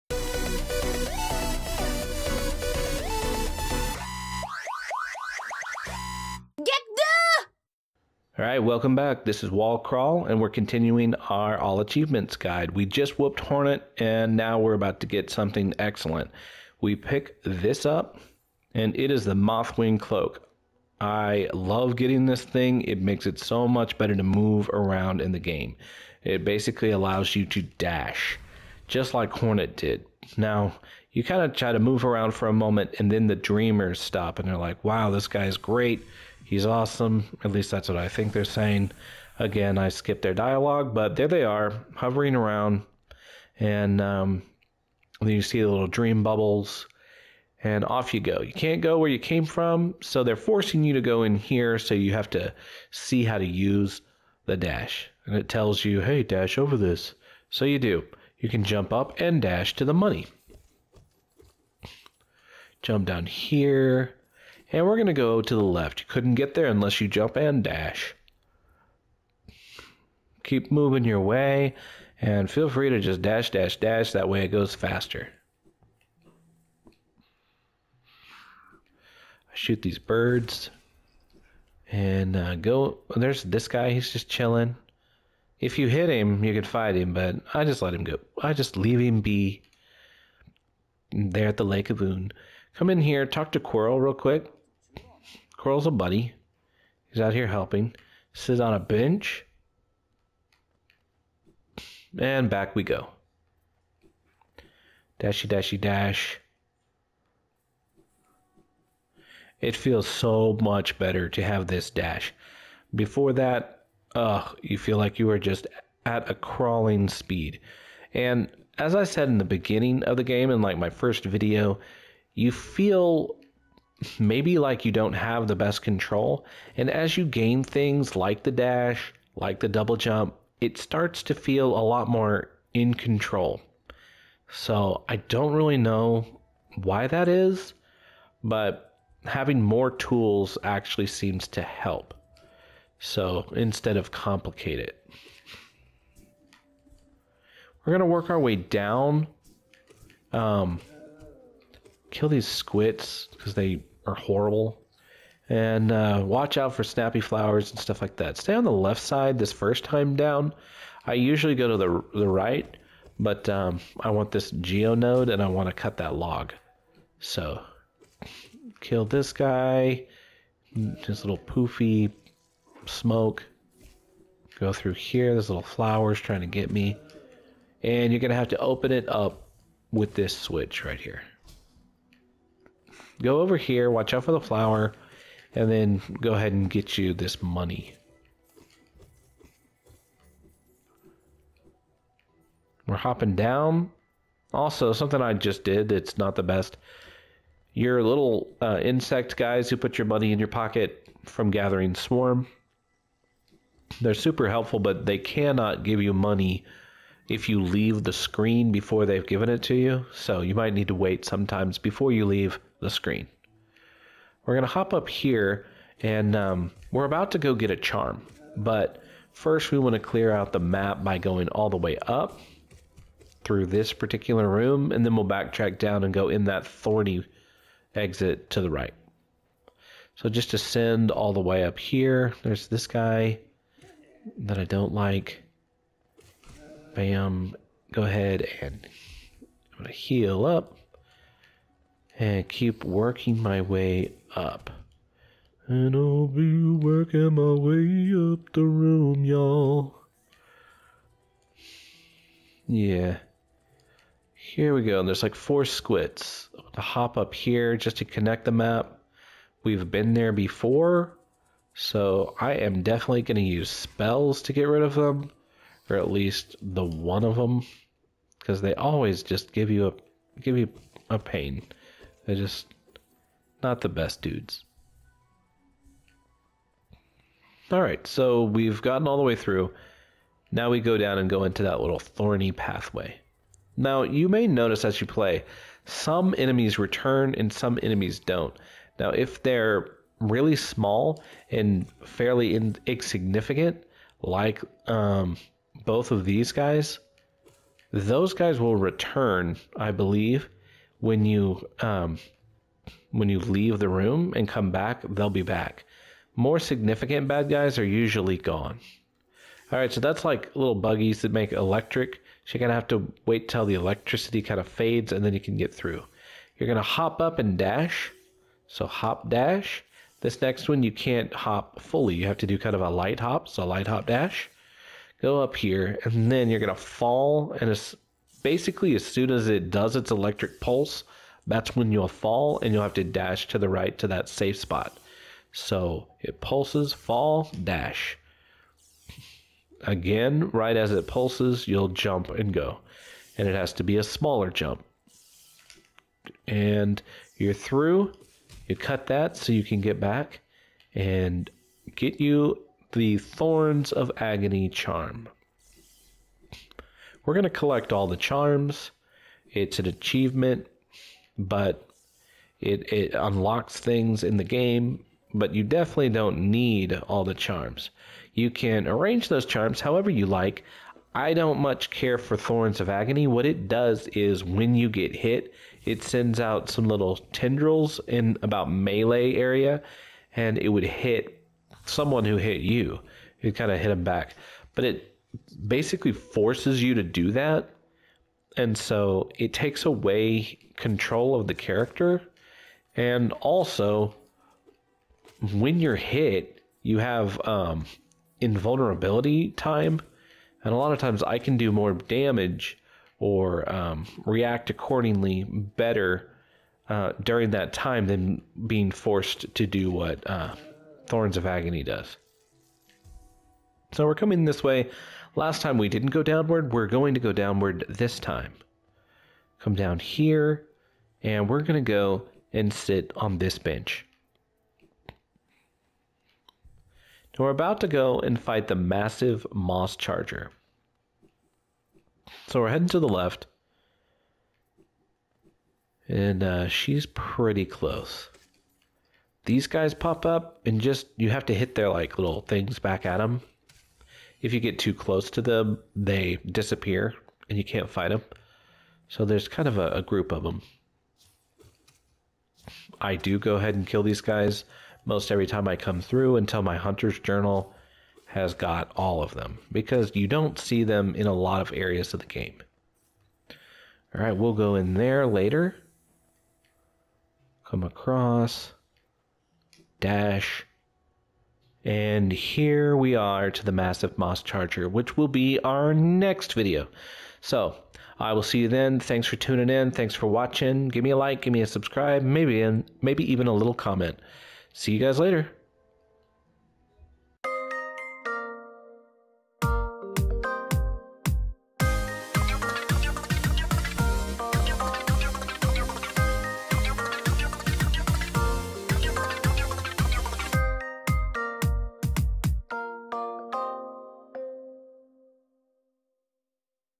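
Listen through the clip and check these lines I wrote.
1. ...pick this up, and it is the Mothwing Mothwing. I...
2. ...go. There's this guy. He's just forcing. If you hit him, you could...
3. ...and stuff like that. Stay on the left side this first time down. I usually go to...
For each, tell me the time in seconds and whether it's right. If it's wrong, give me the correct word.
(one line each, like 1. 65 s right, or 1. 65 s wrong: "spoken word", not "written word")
1. 16 s wrong: "Cloak", not "Mothwing"
2. 82 s wrong: "chilling", not "forcing"
3. 157 s right.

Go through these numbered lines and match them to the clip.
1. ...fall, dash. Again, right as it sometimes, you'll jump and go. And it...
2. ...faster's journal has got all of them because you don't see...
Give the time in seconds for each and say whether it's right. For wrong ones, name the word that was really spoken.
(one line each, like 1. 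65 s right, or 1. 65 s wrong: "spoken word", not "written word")
1. 336 s wrong: "pulses", not "sometimes"
2. 456 s wrong: "hunter", not "faster".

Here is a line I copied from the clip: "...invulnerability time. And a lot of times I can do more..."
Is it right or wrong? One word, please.
right.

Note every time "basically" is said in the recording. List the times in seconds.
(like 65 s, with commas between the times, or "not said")
26 s, 328 s, 385 s.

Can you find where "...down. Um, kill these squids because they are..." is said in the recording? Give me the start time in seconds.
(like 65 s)
148 s.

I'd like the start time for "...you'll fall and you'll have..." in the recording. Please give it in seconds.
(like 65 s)
331 s.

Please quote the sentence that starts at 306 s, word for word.
More significant bad guys are usually gone.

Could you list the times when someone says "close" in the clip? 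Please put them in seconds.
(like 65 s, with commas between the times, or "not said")
437 s, 444 s.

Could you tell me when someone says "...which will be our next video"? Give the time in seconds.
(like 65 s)
474 s.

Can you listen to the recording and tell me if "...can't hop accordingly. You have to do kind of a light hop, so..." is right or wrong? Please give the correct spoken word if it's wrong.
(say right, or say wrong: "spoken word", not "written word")
wrong: "fully", not "accordingly".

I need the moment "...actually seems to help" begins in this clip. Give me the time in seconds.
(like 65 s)
140 s.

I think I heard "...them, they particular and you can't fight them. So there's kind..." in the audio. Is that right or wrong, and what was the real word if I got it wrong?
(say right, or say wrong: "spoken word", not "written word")
wrong: "disappear", not "particular".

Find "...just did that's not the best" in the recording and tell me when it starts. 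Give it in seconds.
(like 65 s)
195 s.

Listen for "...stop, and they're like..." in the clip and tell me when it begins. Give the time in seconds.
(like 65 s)
33 s.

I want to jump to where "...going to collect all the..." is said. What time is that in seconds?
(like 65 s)
357 s.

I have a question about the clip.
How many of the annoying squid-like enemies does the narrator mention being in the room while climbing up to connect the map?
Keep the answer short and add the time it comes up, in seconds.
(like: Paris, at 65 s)
4, at 255 s.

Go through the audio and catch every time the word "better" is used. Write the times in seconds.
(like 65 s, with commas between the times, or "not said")
23 s, 110 s, 405 s.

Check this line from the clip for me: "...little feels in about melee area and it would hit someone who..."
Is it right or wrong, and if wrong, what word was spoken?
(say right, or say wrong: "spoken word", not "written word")
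wrong: "tendrils", not "feels".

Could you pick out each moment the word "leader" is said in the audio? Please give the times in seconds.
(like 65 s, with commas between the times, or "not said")
not said.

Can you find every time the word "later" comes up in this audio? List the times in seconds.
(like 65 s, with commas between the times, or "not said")
465 s, 485 s.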